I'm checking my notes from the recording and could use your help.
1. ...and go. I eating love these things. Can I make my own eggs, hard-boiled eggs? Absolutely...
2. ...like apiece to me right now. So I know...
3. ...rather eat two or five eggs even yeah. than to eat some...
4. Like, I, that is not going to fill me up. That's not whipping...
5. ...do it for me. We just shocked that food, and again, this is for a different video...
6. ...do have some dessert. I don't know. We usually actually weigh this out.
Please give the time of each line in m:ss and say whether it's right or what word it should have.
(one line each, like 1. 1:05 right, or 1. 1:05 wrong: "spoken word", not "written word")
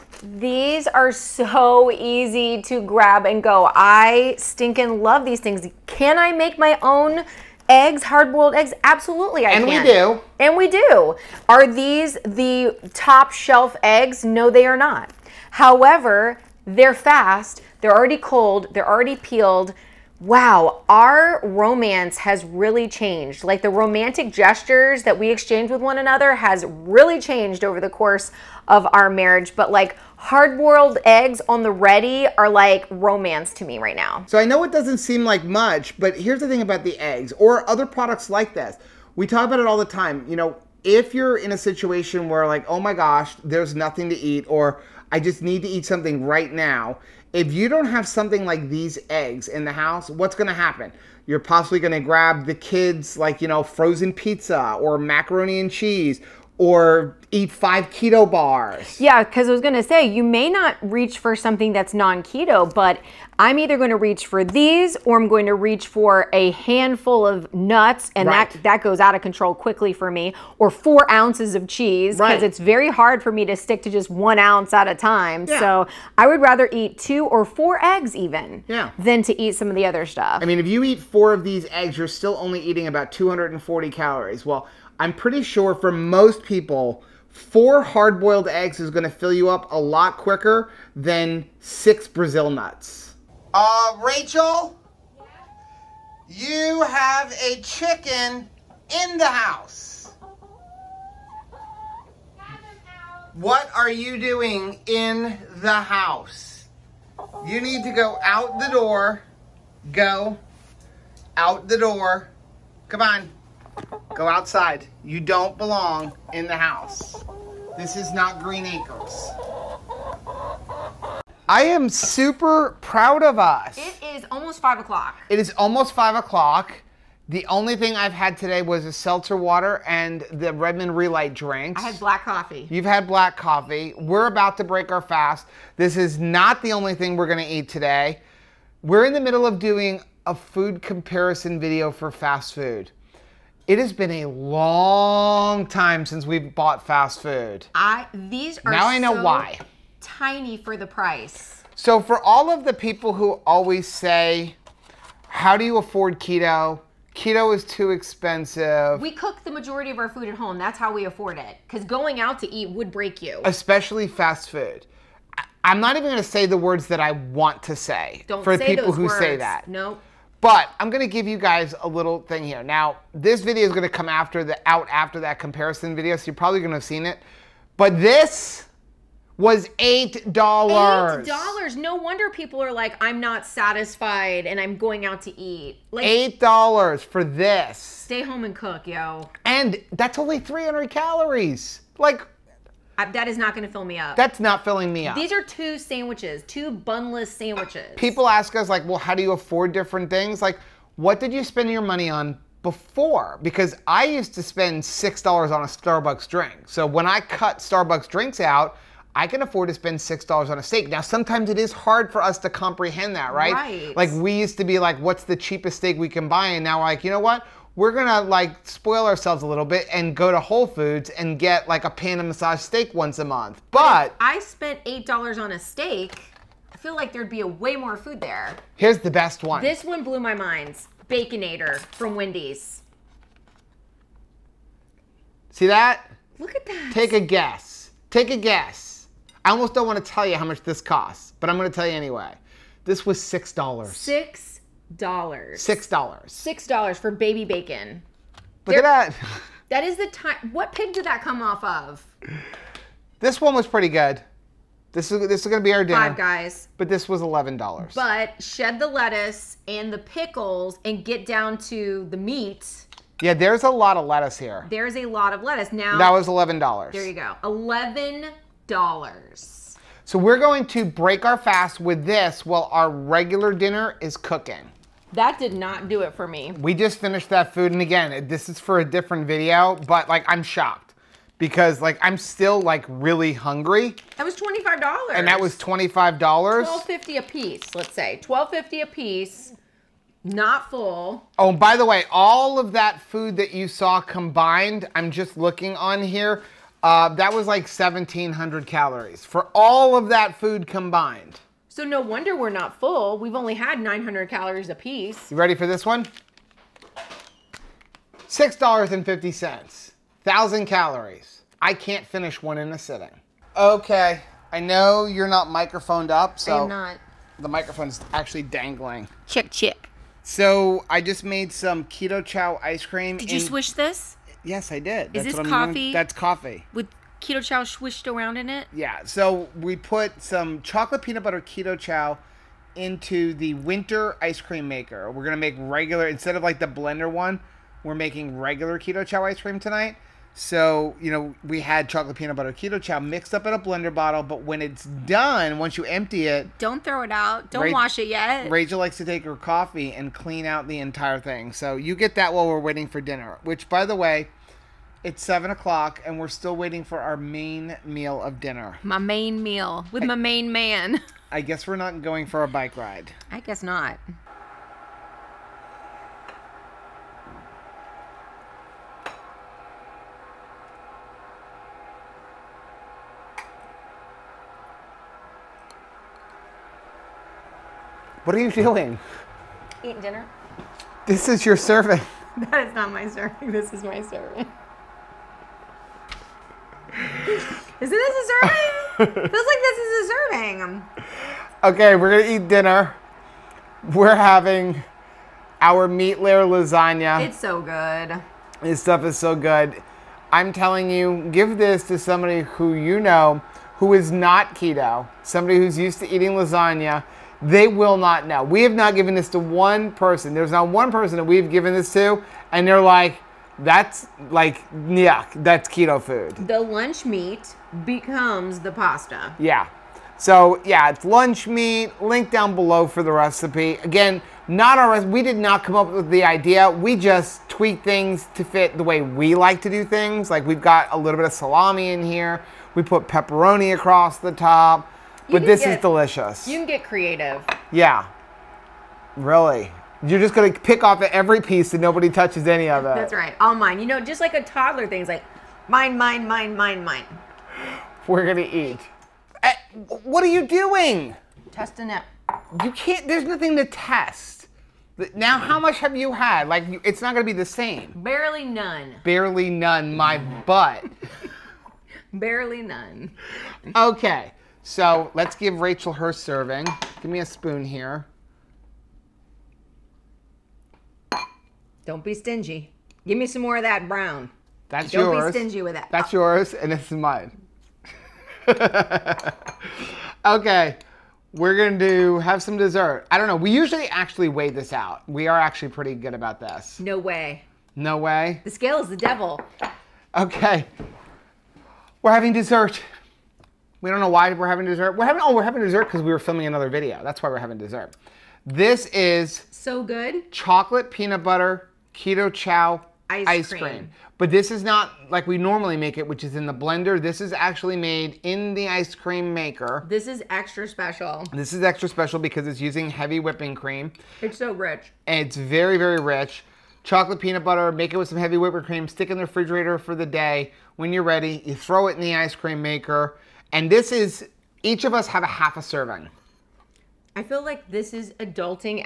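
1. 0:03 wrong: "stinking", not "eating"
2. 0:32 wrong: "romance", not "apiece"
3. 1:16 wrong: "four", not "five"
4. 3:11 wrong: "filling", not "whipping"
5. 4:35 wrong: "finished", not "shocked"
6. 8:01 right.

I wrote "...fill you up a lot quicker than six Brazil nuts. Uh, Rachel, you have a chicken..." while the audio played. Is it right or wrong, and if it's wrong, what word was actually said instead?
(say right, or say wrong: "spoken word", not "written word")
right.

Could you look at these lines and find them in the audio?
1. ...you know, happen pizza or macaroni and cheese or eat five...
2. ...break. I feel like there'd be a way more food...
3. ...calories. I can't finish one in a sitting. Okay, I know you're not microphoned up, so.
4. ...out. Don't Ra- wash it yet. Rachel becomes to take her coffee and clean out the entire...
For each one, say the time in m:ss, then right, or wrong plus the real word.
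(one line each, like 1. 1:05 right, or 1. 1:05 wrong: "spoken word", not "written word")
1. 0:53 wrong: "frozen", not "happen"
2. 3:45 wrong: "steak", not "break"
3. 5:10 right
4. 5:47 wrong: "likes", not "becomes".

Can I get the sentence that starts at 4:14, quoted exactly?
This is this is gonna be our dinner.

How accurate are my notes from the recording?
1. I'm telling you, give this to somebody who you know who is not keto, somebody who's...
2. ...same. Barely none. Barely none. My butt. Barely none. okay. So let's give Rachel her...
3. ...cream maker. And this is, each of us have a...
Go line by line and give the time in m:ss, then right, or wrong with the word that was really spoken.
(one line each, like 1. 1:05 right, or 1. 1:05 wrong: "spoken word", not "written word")
1. 6:40 right
2. 7:37 right
3. 8:42 right.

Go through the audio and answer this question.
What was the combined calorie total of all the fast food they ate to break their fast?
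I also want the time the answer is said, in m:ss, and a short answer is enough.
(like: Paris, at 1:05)
1,700, at 4:57.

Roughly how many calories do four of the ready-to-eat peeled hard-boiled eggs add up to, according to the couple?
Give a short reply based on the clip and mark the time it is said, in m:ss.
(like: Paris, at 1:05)
240, at 1:23.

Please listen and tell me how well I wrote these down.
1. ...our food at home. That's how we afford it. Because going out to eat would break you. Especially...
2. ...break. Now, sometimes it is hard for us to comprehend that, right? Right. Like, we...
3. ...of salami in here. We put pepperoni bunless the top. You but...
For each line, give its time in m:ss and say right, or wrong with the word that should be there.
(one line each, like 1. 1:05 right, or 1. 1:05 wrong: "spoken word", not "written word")
1. 2:39 right
2. 3:30 wrong: "steak", not "break"
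3. 7:11 wrong: "across", not "bunless".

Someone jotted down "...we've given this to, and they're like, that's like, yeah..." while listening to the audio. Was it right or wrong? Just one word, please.
right.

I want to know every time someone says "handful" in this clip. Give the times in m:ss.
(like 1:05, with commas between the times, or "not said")
1:06.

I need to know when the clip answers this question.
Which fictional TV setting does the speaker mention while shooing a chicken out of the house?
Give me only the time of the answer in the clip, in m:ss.
1:58.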